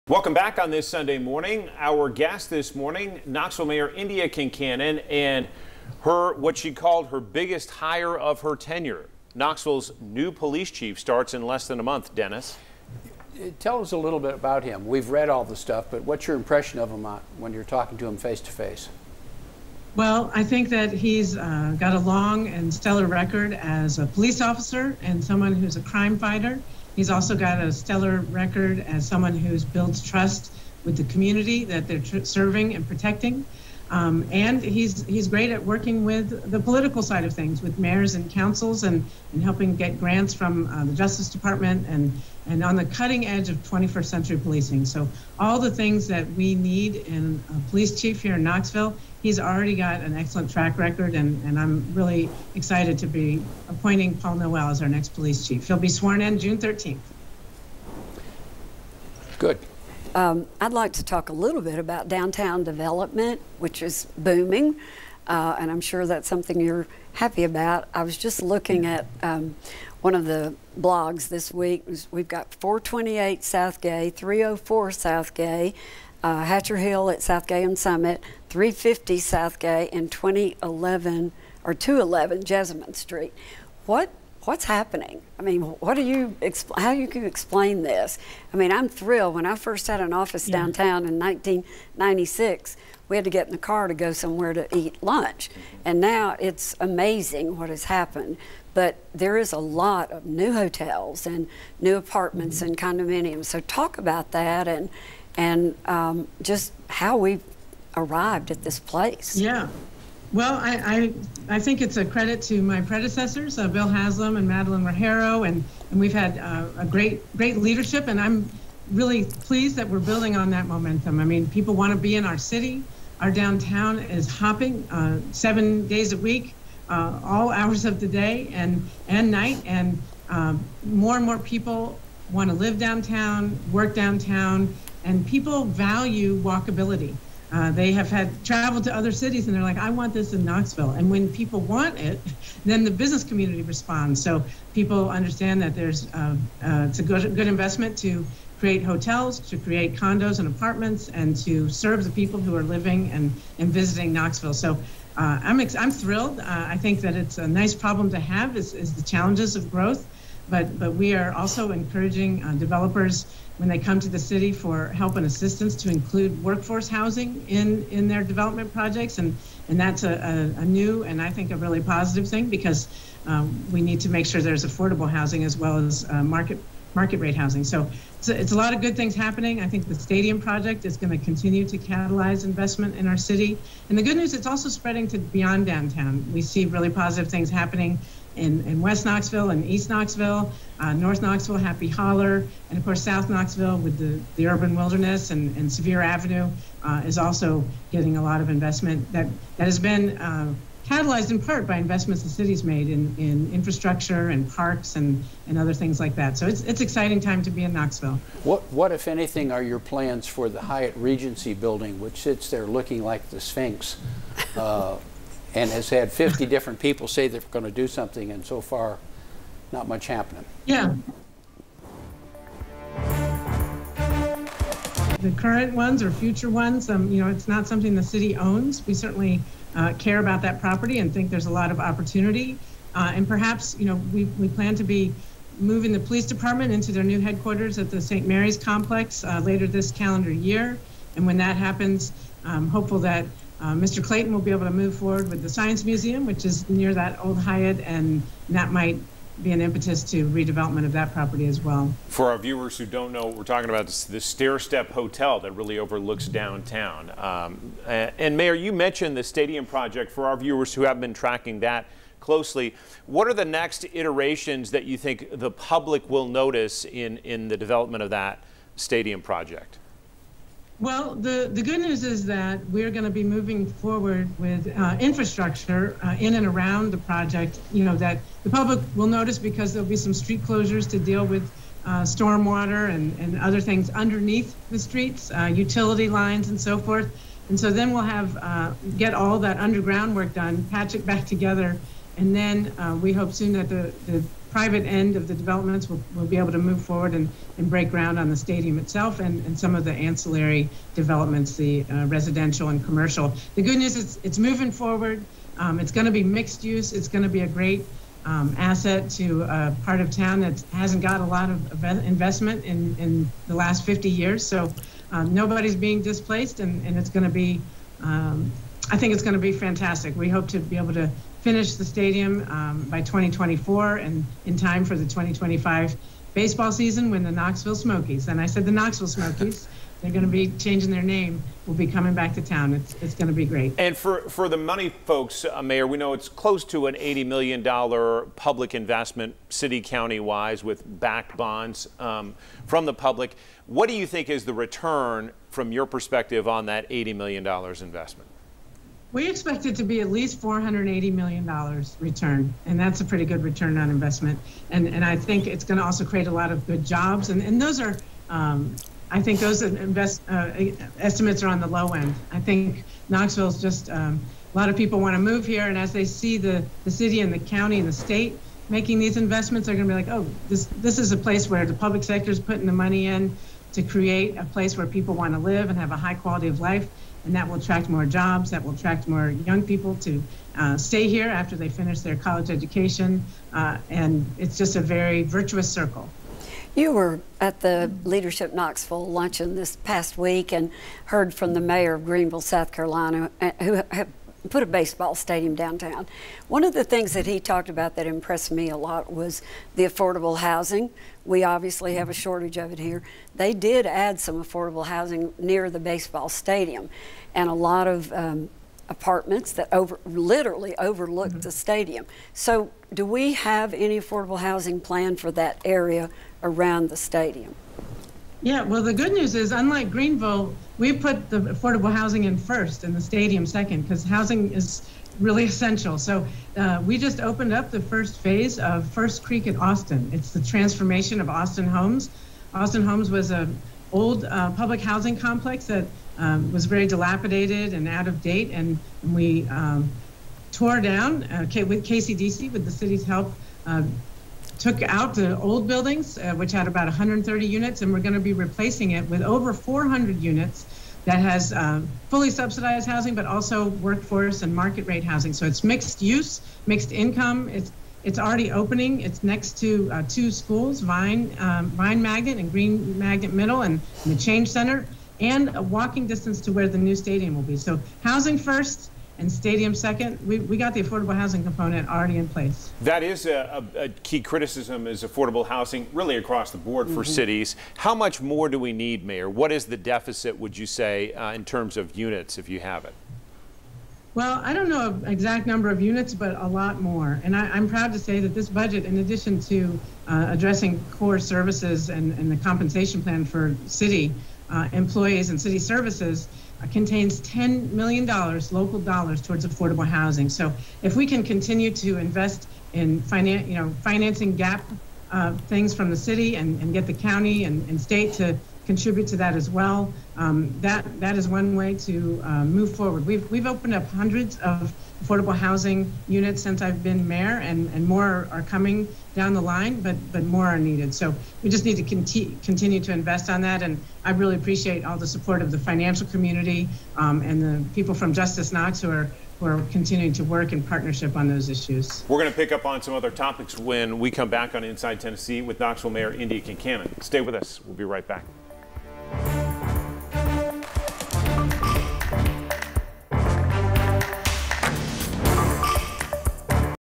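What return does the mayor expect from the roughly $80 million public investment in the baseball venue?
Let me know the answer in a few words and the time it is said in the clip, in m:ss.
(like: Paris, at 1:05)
$480 million, at 5:50.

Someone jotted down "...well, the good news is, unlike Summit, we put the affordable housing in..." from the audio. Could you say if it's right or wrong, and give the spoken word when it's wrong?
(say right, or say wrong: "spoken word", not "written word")
wrong: "Greenville", not "Summit".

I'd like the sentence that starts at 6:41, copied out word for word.
We obviously have a shortage of it here.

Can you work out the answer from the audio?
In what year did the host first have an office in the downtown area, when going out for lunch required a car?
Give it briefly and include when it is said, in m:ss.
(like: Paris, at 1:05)
1996, at 1:31.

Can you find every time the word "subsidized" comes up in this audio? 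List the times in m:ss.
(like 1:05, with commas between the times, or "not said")
7:32.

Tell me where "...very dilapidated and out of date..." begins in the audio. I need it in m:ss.
7:16.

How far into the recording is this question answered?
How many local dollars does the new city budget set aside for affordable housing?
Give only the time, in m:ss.
8:17.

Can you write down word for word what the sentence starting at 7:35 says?
So it's mixed use, mixed income.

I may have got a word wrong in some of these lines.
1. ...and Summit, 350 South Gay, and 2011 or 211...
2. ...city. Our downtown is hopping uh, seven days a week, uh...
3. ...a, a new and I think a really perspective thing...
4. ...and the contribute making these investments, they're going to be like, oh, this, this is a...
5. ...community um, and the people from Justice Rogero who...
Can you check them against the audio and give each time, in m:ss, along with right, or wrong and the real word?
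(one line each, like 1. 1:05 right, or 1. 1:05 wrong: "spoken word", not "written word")
1. 1:17 right
2. 2:02 right
3. 2:50 wrong: "positive", not "perspective"
4. 6:07 wrong: "state", not "contribute"
5. 8:46 wrong: "Knox", not "Rogero".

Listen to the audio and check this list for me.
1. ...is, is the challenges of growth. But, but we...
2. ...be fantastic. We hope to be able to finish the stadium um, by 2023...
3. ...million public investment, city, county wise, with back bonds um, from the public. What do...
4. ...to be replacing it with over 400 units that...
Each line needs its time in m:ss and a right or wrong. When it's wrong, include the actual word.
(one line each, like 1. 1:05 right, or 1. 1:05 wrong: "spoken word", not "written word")
1. 2:38 right
2. 5:19 wrong: "2024", not "2023"
3. 5:37 right
4. 7:28 right.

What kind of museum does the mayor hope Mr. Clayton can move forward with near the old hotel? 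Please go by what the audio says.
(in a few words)
Science Museum.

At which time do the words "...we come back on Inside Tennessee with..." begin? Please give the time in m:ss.
8:53.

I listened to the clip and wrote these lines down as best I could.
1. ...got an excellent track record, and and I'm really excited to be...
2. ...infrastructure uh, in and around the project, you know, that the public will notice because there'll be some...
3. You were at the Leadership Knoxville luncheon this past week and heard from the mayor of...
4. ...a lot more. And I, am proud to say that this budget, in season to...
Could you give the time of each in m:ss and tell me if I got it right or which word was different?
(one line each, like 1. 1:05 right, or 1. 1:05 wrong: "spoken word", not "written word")
1. 0:49 right
2. 4:34 right
3. 6:26 right
4. 8:06 wrong: "addition", not "season".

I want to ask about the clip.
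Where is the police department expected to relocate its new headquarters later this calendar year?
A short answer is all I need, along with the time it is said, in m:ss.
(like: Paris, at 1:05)
St. Mary's complex, at 3:58.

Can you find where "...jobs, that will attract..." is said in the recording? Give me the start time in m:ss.
6:18.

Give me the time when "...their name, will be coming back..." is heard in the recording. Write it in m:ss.
5:30.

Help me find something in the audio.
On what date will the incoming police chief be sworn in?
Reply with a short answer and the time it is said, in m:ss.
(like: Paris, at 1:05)
June 13th, at 0:56.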